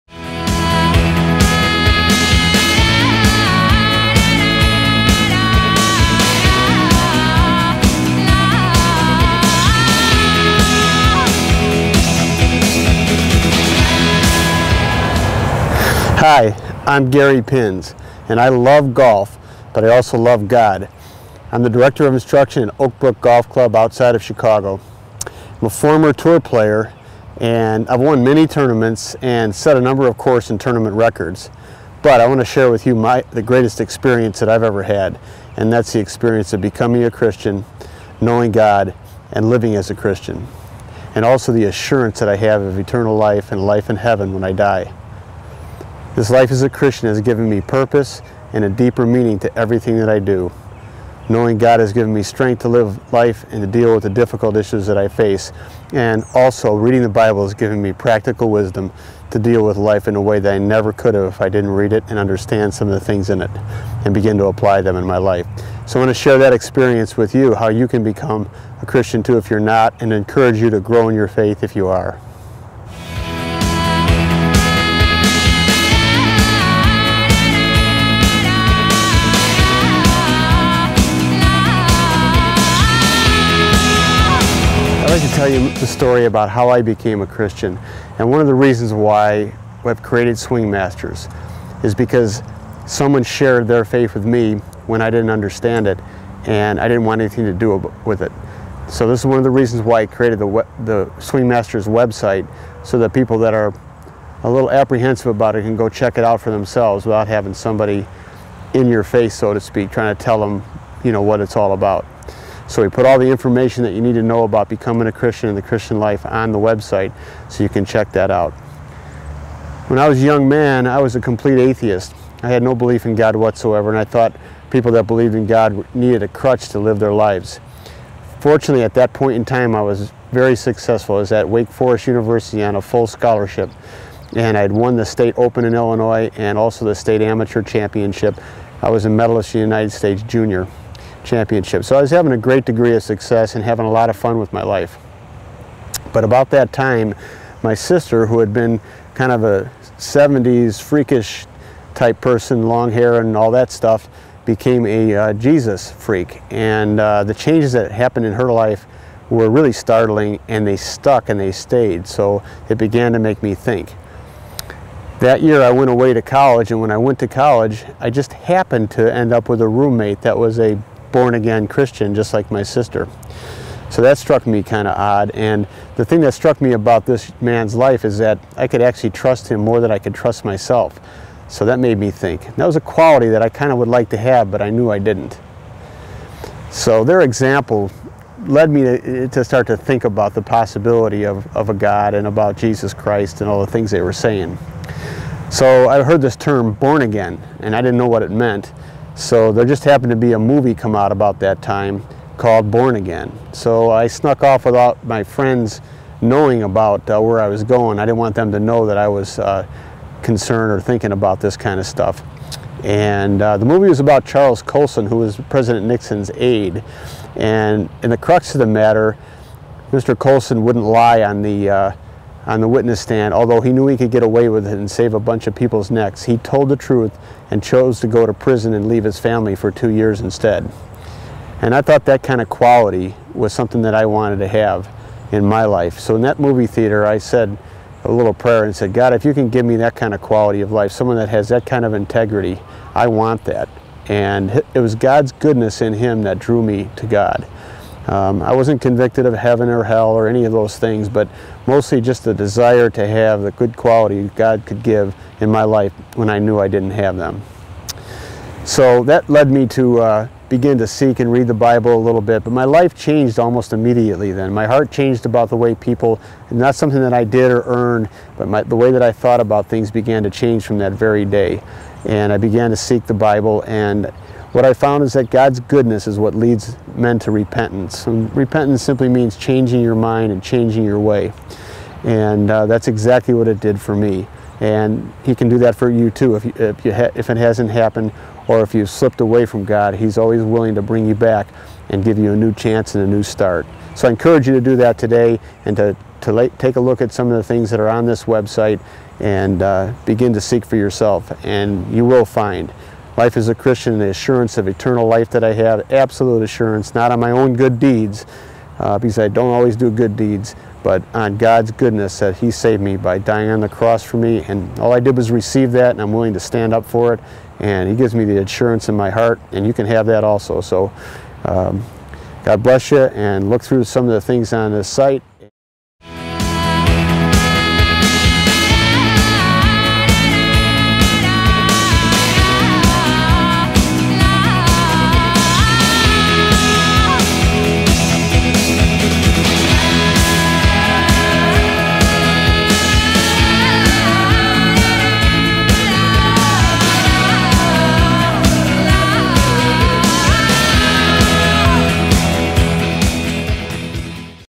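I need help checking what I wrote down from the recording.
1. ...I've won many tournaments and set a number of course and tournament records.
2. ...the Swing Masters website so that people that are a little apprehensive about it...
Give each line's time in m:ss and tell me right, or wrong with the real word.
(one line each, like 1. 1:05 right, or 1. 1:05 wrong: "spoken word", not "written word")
1. 0:27 right
2. 1:40 right.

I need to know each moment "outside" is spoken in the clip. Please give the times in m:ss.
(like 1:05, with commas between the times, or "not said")
0:23.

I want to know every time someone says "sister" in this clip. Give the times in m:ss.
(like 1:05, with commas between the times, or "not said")
2:27, 2:52.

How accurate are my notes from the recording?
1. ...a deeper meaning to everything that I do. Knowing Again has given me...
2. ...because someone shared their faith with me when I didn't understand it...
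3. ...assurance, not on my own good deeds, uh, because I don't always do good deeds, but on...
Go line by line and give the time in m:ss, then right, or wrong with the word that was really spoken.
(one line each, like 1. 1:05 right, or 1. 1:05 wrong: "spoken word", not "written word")
1. 0:48 wrong: "God", not "Again"
2. 1:31 right
3. 5:06 right.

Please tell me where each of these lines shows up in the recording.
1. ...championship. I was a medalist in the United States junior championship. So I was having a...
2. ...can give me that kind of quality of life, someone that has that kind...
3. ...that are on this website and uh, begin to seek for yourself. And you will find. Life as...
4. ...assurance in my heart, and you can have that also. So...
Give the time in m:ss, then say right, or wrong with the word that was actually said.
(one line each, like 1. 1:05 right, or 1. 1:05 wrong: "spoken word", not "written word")
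1. 2:17 right
2. 3:59 right
3. 4:57 right
4. 5:18 right.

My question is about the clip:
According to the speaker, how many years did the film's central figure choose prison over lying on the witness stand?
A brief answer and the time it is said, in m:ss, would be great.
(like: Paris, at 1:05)
2, at 3:49.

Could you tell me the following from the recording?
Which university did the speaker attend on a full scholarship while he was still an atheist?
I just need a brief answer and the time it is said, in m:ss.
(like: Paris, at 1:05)
Wake Forest University, at 2:11.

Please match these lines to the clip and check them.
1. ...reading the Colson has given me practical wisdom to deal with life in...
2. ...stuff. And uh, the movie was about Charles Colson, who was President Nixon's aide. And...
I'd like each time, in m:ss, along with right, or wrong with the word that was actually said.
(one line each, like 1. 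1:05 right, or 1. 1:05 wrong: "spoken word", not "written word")
1. 0:56 wrong: "Bible", not "Colson"
2. 3:31 right.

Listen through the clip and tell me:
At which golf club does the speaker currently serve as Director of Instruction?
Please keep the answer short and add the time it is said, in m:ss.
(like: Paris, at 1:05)
Oakbrook Golf Club, at 0:22.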